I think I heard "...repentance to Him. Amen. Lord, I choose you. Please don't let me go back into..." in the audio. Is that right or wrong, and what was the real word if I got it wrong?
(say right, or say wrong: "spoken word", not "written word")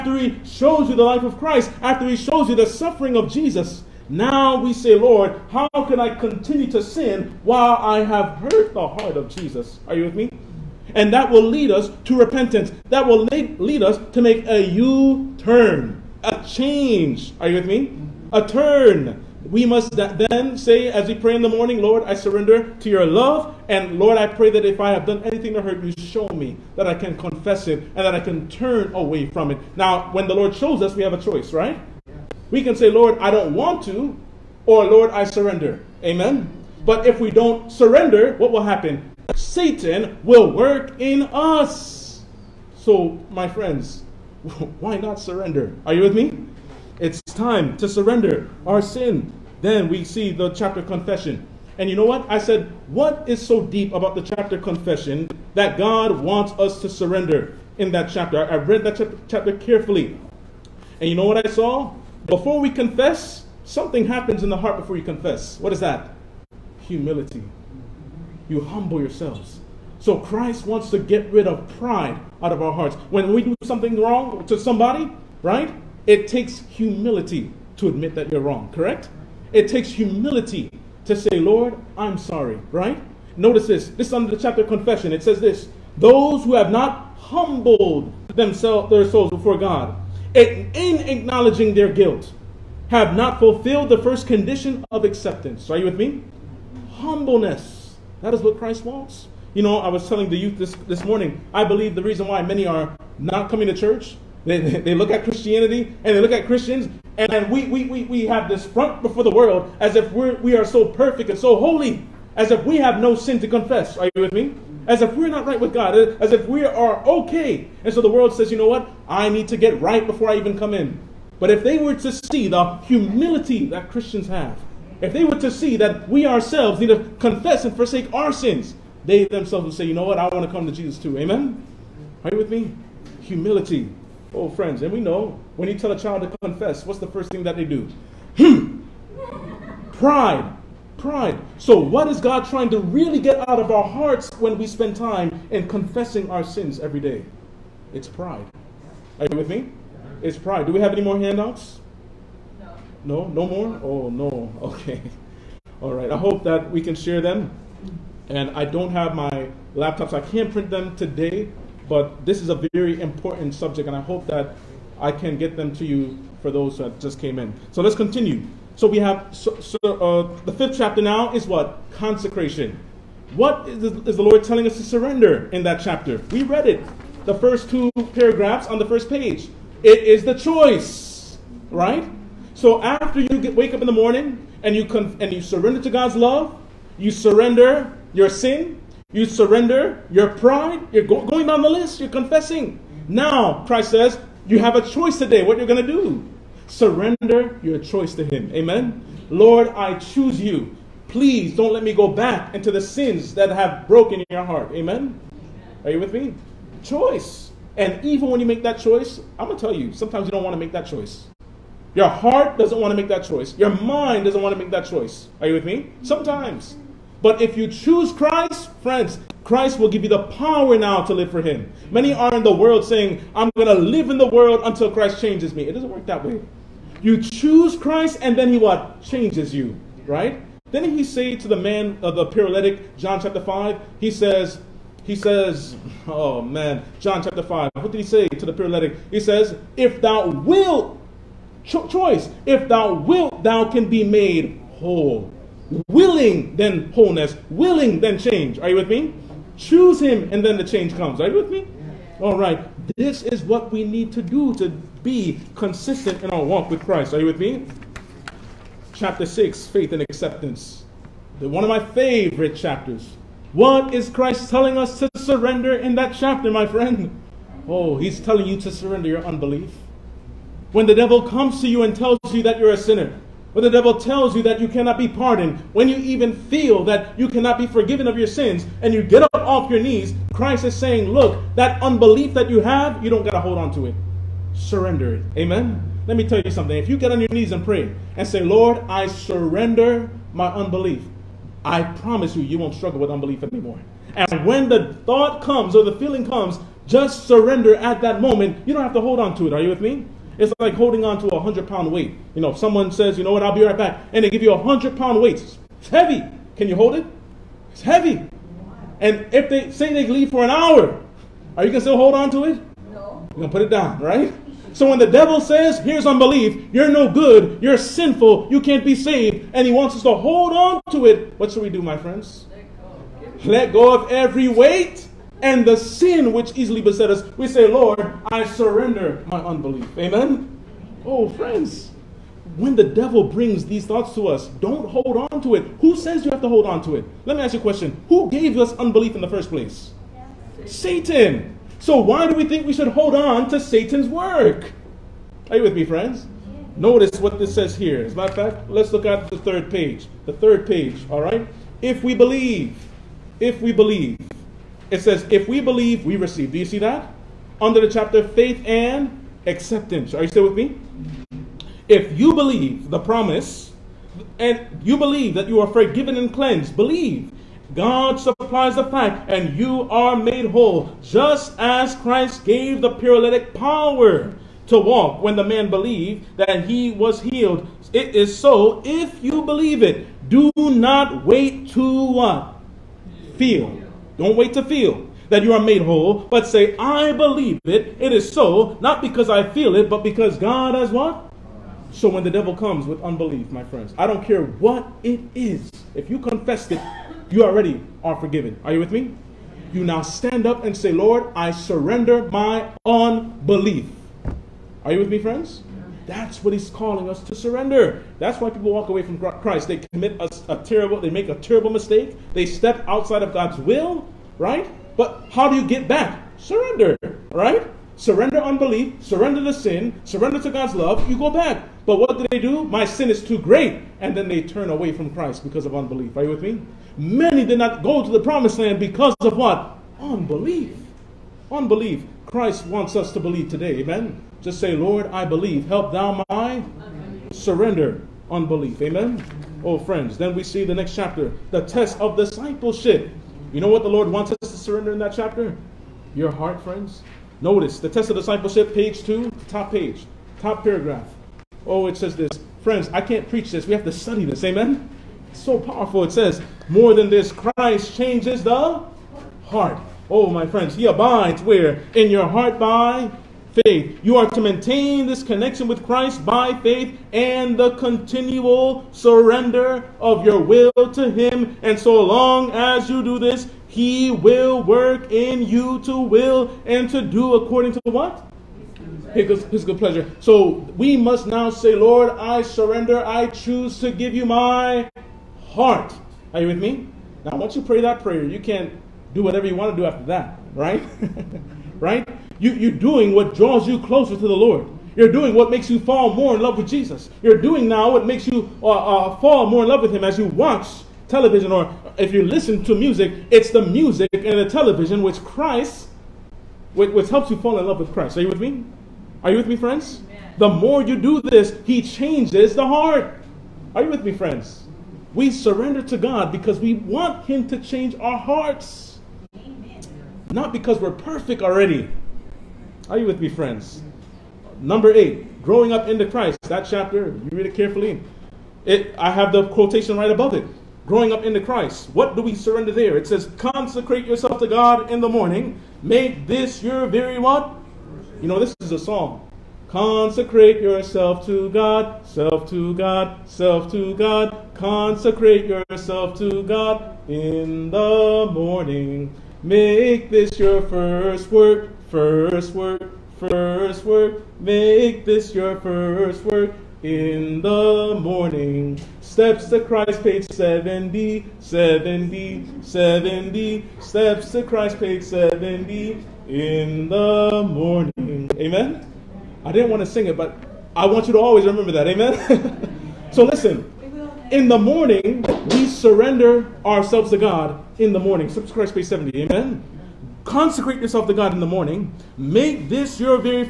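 wrong: "choice", not "repentance".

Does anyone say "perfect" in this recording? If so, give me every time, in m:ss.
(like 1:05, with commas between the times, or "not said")
1:50, 8:40.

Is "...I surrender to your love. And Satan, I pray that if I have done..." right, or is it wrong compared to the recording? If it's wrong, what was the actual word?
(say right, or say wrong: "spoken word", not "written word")
wrong: "Lord", not "Satan".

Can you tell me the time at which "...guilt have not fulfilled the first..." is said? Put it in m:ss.
1:31.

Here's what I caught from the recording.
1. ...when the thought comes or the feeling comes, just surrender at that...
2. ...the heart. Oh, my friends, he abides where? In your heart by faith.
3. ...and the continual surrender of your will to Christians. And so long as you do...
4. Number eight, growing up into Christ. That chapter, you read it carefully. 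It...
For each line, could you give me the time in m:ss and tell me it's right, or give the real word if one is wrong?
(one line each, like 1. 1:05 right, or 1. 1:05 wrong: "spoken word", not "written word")
1. 4:54 right
2. 7:38 right
3. 7:47 wrong: "Him", not "Christians"
4. 8:44 right.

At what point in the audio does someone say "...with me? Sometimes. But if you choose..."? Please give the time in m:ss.
3:35.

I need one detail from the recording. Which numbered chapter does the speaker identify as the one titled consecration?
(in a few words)
5.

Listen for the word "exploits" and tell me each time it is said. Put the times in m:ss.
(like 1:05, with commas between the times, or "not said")
not said.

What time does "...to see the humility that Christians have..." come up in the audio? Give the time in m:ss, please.
2:01.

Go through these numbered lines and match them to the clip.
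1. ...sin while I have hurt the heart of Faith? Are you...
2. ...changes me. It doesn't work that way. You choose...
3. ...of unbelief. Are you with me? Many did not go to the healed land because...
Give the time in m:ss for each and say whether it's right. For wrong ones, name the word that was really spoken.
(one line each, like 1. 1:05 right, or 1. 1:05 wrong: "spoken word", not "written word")
1. 0:06 wrong: "Jesus", not "Faith"
2. 3:45 right
3. 7:05 wrong: "promised", not "healed".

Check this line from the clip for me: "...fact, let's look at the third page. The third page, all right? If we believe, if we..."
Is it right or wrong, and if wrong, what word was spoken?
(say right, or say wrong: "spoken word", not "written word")
right.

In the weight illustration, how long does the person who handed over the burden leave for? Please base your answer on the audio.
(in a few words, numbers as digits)
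An hour.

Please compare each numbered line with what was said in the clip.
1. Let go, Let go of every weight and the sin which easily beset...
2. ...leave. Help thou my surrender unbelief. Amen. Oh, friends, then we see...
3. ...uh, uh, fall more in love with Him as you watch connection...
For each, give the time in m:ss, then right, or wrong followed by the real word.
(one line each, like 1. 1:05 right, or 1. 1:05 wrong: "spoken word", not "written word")
1. 5:22 right
2. 7:15 wrong: "believe", not "leave"
3. 8:18 wrong: "television", not "connection".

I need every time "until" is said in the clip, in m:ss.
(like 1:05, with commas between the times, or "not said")
3:44.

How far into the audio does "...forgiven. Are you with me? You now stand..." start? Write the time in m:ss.
6:38.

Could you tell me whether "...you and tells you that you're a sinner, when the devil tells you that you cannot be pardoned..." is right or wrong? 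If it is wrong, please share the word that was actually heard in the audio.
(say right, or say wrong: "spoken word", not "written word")
right.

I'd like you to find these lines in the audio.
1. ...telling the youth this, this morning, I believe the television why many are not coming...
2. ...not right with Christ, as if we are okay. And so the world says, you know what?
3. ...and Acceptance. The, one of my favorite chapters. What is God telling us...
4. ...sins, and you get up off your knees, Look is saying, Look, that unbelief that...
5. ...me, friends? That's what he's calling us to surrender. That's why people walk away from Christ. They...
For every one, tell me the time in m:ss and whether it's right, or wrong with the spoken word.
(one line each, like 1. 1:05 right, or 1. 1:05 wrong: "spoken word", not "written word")
1. 1:40 wrong: "reason", not "television"
2. 1:55 wrong: "God", not "Christ"
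3. 4:19 wrong: "Christ", not "God"
4. 4:38 wrong: "Christ", not "Look"
5. 6:45 right.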